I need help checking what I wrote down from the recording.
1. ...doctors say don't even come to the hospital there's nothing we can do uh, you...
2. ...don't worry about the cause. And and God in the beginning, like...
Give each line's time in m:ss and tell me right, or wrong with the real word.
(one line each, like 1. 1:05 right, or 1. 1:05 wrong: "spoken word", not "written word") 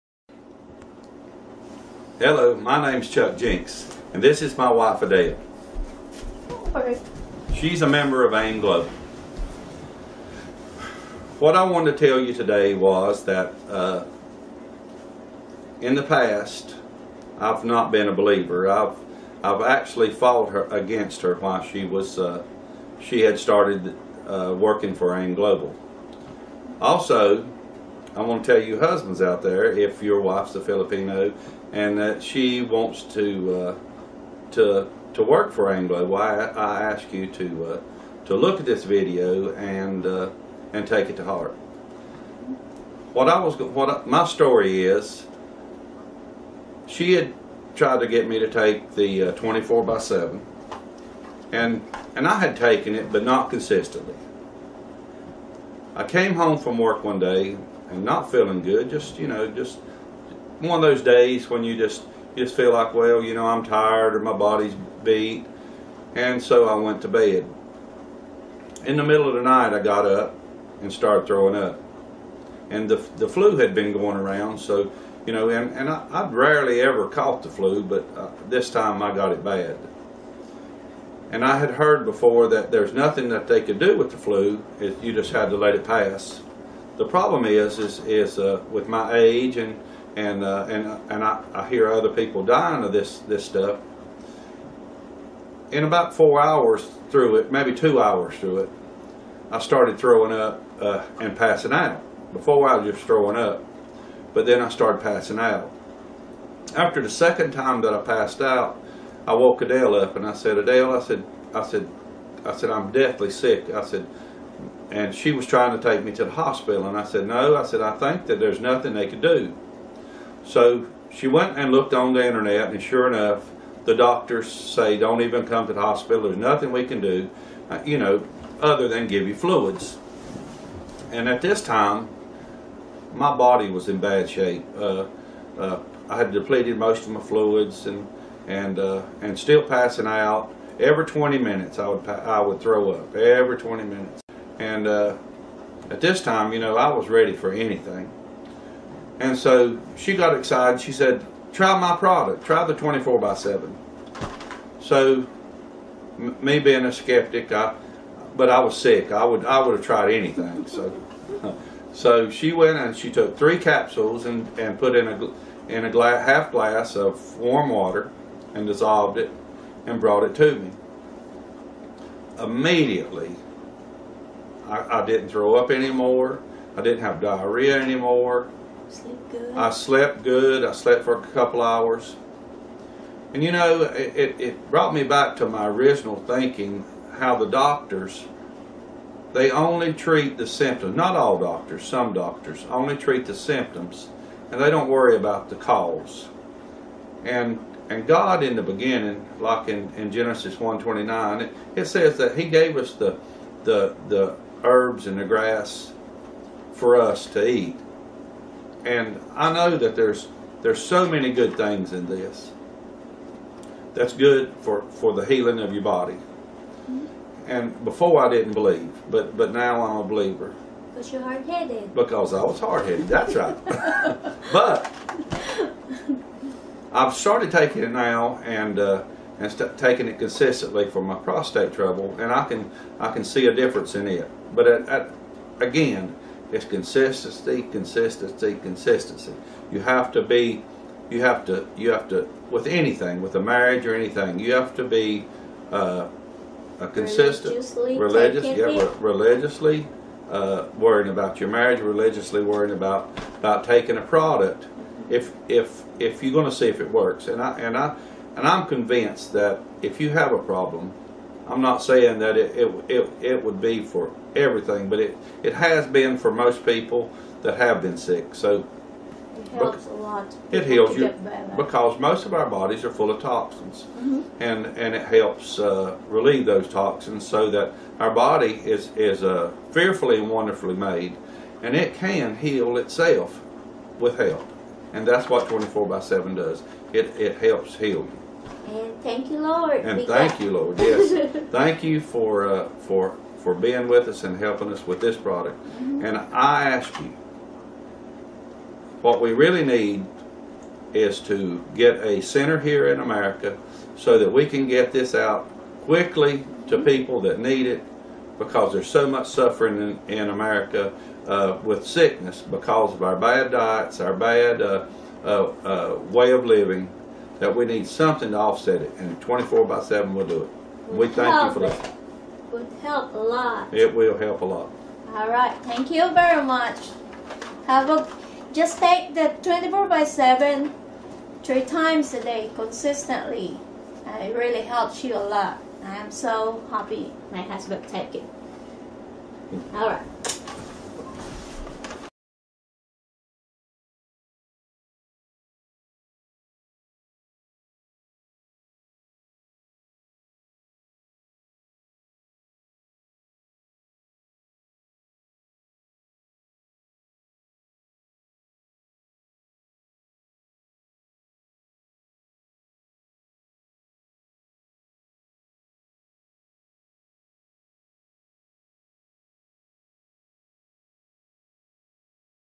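1. 2:03 right
2. 3:14 right.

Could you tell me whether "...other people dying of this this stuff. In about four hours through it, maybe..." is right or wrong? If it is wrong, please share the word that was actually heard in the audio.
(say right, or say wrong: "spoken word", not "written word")
right.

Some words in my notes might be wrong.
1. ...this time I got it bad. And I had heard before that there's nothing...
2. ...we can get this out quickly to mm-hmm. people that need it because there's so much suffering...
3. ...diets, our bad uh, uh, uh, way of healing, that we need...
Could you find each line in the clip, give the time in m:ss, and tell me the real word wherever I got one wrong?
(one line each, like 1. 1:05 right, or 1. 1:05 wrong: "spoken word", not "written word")
1. 1:18 right
2. 5:04 right
3. 5:13 wrong: "living", not "healing".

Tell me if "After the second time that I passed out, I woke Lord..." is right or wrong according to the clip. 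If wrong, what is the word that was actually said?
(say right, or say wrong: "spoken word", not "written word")
wrong: "Adele", not "Lord".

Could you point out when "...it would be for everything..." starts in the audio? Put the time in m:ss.
4:23.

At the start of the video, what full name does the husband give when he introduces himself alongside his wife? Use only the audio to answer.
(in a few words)
Chuck Jenks.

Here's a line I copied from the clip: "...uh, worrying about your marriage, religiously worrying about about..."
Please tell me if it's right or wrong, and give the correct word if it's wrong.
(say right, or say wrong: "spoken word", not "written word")
right.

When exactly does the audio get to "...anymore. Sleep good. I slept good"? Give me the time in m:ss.
2:57.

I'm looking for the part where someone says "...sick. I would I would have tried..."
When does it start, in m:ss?
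2:38.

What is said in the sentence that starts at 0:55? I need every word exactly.
I came home from work one day, and not feeling good.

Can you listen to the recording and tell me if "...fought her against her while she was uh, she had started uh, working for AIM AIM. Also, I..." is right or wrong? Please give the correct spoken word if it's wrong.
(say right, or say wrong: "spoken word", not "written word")
wrong: "Global", not "AIM".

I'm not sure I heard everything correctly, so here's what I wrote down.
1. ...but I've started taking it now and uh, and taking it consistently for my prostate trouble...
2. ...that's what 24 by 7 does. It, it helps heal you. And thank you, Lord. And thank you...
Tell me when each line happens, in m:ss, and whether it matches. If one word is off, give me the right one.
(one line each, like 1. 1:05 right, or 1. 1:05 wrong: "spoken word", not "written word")
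1. 3:44 right
2. 4:45 right.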